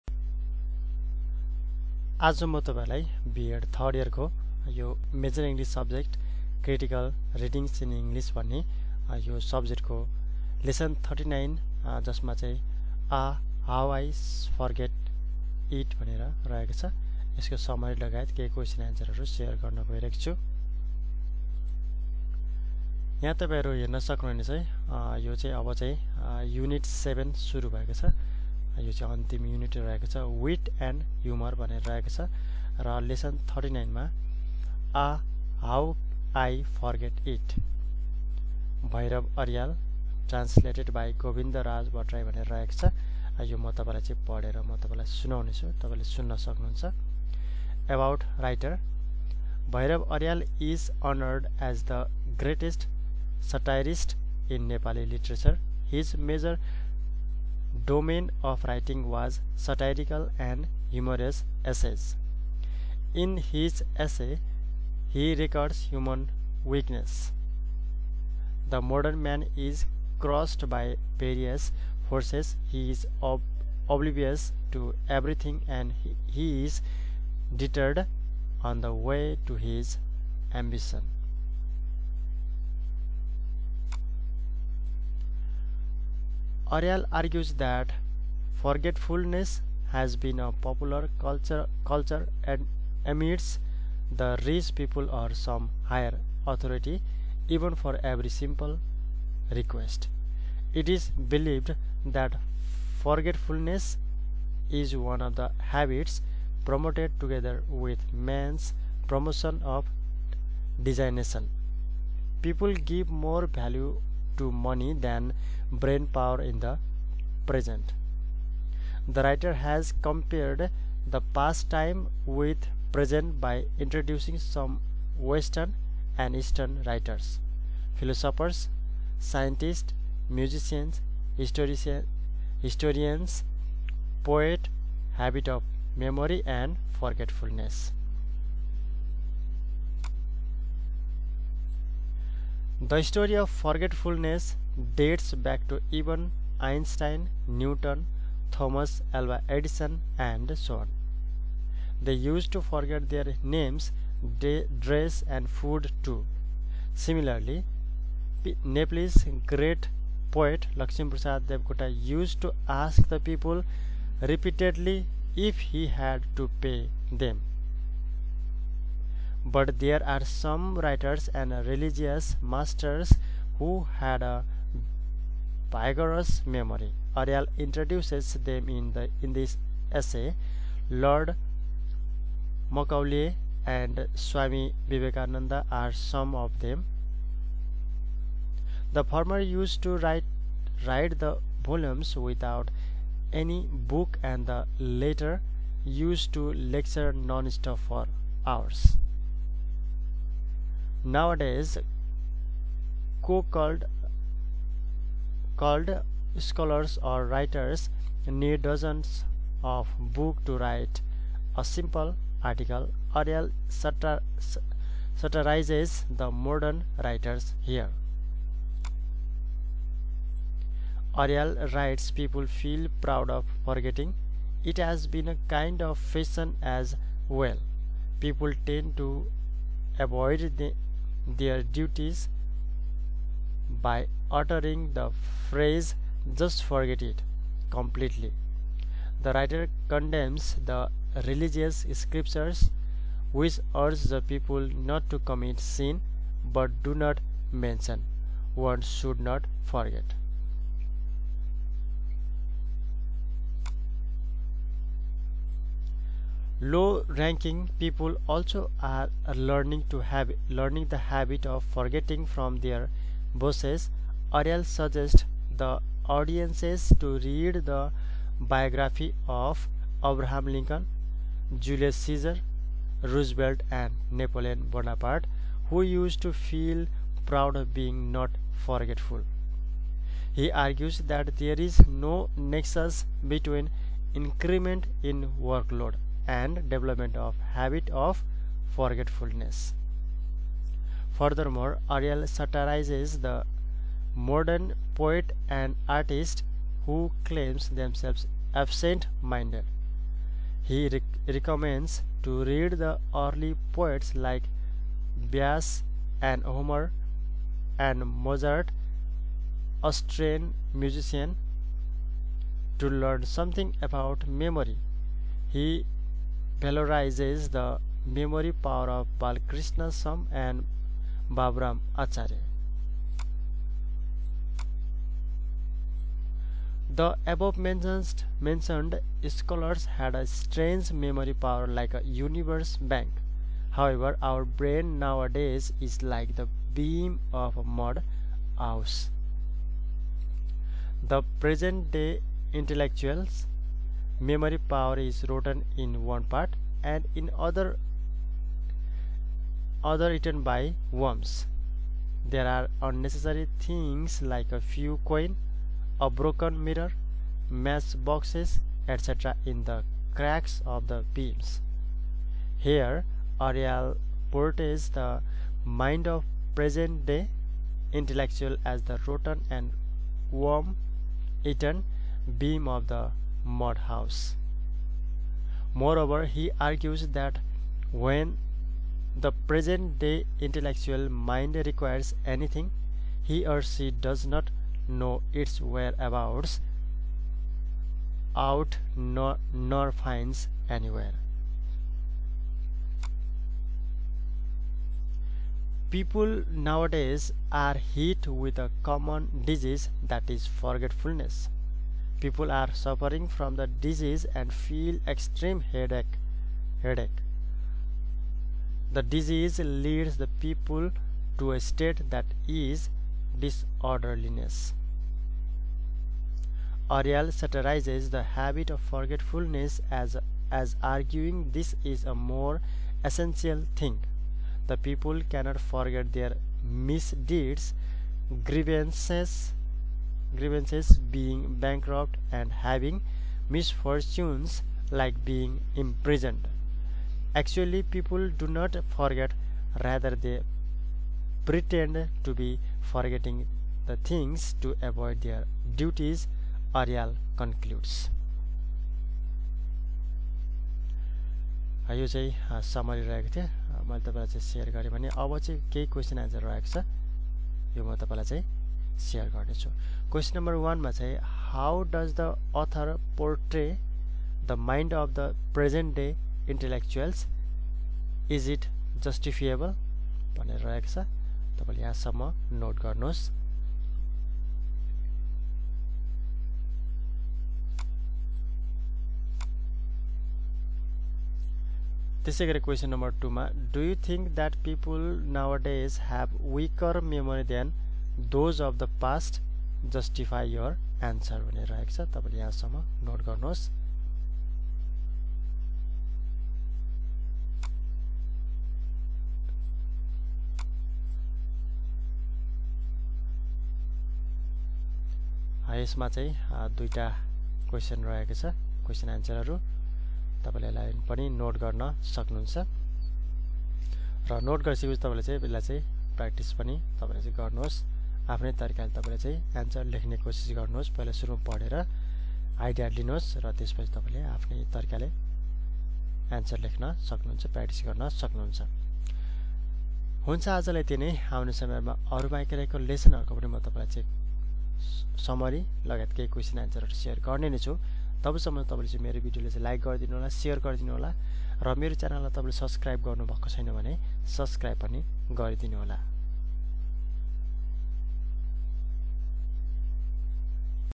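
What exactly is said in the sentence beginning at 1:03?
In his essay, he records human weakness.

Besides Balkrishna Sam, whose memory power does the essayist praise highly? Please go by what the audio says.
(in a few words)
Baburam Acharya.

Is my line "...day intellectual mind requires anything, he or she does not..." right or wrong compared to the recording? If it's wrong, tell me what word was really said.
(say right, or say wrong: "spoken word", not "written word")
right.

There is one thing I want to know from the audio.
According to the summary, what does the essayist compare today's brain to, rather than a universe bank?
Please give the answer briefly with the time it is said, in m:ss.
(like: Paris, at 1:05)
beam of a mud house, at 5:36.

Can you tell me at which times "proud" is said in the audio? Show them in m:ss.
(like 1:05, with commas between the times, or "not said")
3:43, 4:37.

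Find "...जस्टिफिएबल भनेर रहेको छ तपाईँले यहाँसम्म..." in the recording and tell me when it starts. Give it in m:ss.
7:49.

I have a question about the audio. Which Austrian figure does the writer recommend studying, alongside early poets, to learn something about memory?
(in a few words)
Mozart.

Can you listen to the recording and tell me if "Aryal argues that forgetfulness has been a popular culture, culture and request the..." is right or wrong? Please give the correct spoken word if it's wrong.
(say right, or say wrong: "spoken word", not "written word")
wrong: "amidst", not "request".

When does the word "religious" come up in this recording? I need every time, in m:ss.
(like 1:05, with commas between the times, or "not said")
2:51, 4:01.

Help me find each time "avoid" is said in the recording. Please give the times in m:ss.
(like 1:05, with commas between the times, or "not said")
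3:49, 7:24.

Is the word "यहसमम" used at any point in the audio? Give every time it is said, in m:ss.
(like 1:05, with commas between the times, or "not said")
7:51, 8:12.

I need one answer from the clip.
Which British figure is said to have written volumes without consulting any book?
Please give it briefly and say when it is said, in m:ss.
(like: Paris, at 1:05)
Lord Macaulay, at 3:00.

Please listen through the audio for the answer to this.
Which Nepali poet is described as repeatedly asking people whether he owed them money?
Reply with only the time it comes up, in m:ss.
2:40.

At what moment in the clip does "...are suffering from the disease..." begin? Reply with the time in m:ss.
6:42.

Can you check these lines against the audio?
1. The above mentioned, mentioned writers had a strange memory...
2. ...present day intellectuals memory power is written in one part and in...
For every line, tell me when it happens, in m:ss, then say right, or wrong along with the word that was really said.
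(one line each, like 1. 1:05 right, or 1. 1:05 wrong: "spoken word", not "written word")
1. 5:26 wrong: "scholars", not "writers"
2. 5:41 right.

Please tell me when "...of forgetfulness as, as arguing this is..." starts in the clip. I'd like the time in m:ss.
6:58.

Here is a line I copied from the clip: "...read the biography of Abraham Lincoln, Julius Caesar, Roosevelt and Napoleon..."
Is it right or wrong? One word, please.
right.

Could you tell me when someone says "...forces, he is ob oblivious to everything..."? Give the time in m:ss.
1:12.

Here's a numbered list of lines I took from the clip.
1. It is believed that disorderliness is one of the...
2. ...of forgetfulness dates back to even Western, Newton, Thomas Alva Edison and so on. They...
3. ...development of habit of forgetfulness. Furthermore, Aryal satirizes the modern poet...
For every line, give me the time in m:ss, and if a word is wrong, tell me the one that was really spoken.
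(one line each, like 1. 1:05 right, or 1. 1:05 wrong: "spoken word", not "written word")
1. 1:40 wrong: "forgetfulness", not "disorderliness"
2. 2:23 wrong: "Einstein", not "Western"
3. 4:46 right.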